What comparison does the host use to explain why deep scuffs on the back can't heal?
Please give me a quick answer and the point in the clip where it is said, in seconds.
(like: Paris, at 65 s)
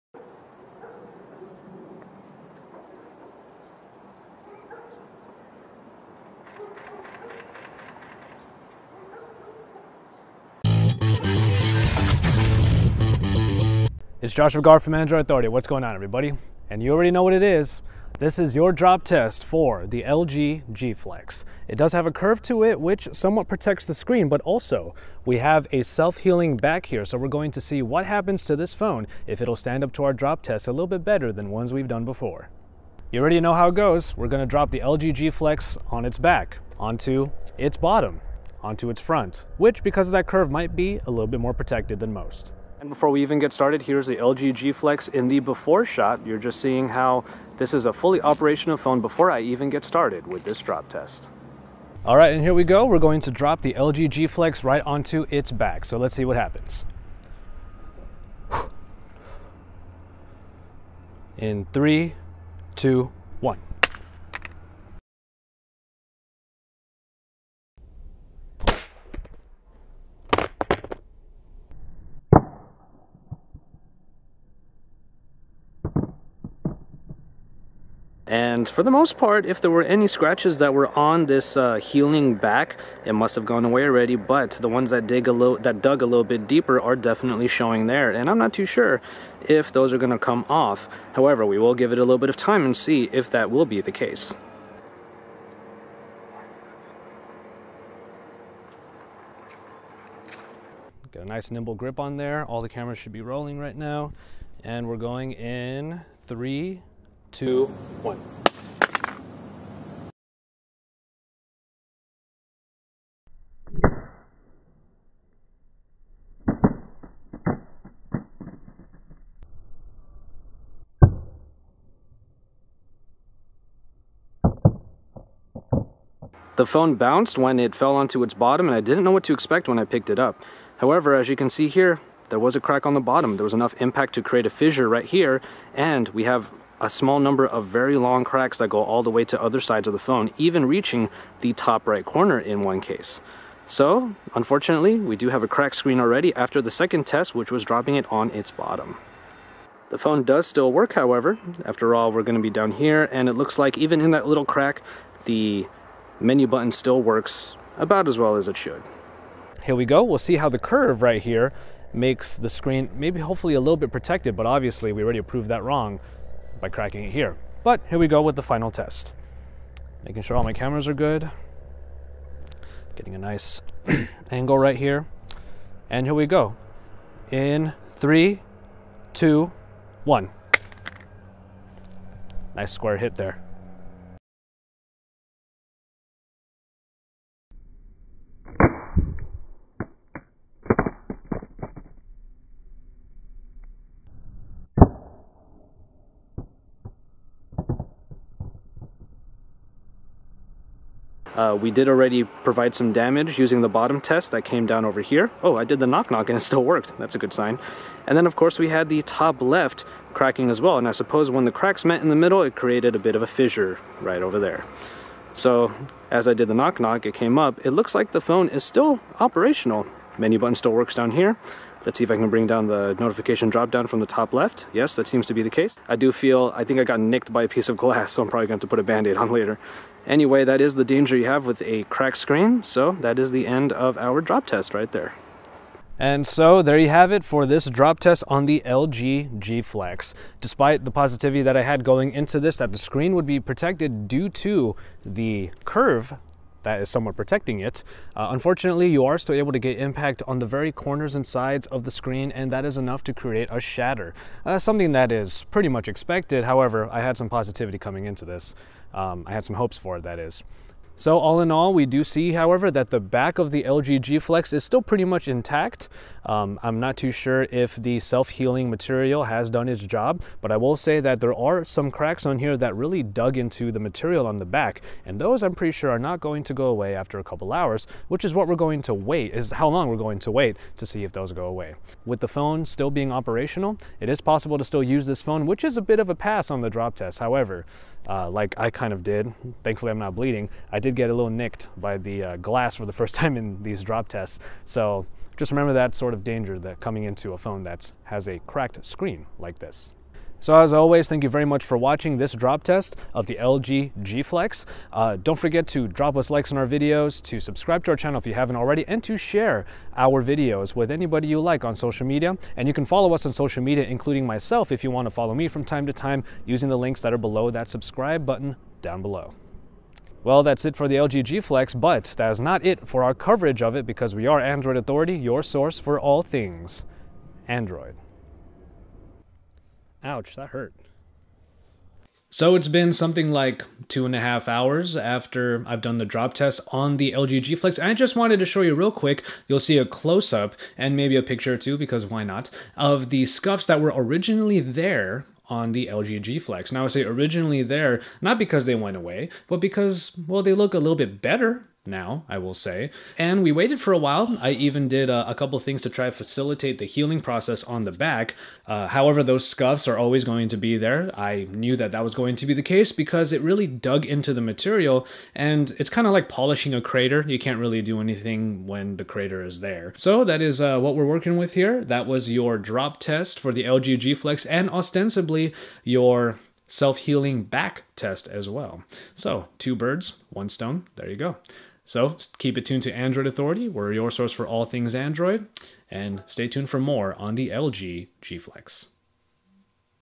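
polishing a crater, at 366 s.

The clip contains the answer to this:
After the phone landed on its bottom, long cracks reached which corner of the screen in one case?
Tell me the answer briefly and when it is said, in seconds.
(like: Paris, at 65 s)
top right corner, at 141 s.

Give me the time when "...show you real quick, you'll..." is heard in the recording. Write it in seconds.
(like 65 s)
338 s.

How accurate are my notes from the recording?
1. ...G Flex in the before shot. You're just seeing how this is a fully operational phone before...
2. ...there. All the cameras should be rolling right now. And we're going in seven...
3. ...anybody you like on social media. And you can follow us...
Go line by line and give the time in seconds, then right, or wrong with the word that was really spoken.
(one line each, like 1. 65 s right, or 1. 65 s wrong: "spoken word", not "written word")
1. 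44 s right
2. 102 s wrong: "three", not "seven"
3. 310 s right.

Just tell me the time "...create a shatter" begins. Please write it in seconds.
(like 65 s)
253 s.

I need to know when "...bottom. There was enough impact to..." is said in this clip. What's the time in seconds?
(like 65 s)
132 s.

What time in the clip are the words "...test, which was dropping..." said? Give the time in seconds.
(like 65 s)
147 s.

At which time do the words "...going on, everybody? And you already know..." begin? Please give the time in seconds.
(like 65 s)
15 s.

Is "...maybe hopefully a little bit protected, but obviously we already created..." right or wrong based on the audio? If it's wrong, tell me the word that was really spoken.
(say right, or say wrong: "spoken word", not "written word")
wrong: "proved", not "created".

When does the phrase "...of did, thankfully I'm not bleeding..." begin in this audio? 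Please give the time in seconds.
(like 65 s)
288 s.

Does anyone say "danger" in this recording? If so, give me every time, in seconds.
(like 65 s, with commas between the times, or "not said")
230 s, 296 s.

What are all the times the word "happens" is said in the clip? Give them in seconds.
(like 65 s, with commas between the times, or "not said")
28 s, 56 s.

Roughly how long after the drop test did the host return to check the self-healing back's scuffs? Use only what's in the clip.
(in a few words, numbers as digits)
2.5 hours.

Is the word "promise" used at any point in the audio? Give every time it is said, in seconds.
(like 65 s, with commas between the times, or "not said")
not said.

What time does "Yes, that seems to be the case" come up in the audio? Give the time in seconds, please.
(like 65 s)
224 s.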